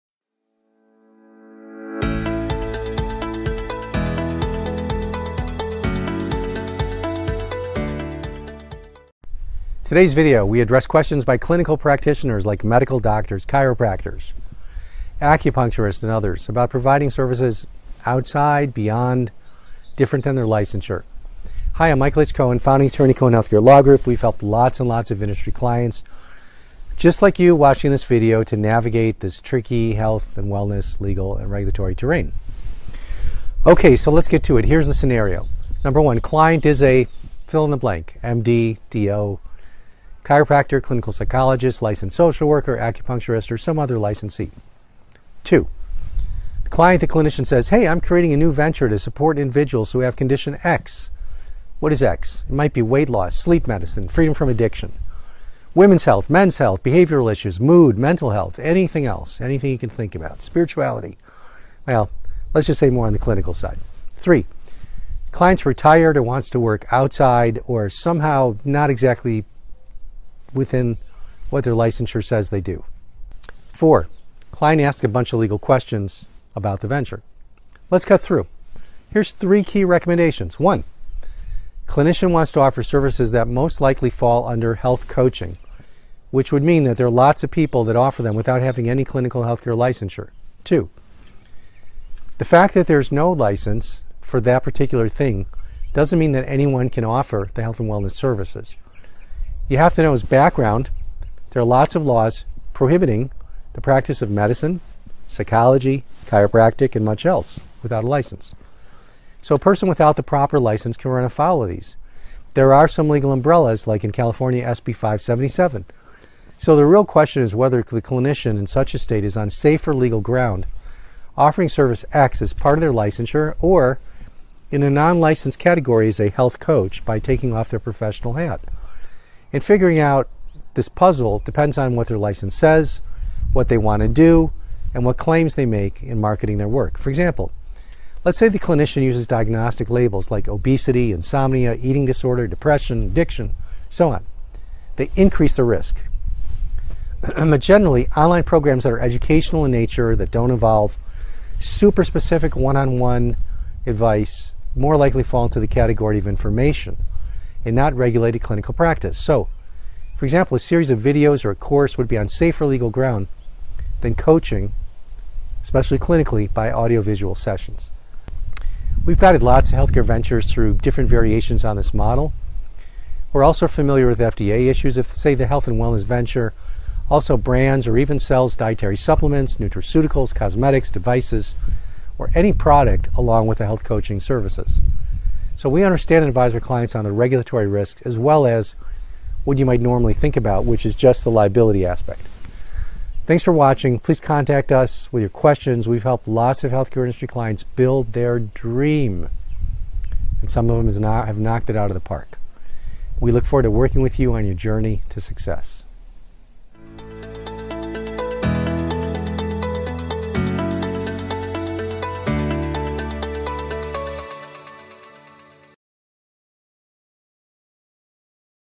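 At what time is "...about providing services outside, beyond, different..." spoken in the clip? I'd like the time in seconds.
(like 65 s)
16 s.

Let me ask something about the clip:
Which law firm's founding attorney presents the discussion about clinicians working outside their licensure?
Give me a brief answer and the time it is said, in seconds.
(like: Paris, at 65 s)
Cohen Healthcare Law Group, at 23 s.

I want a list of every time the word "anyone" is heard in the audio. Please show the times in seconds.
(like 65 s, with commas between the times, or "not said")
96 s.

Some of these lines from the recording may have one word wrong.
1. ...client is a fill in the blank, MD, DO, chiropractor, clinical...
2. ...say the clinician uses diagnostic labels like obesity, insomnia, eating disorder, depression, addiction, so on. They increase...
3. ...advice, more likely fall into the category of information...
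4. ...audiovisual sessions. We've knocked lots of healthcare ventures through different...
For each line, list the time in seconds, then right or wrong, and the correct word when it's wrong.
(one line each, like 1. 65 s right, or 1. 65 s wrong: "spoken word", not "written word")
1. 36 s right
2. 138 s right
3. 153 s right
4. 166 s wrong: "guided", not "knocked".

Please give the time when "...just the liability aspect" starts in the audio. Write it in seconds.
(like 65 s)
190 s.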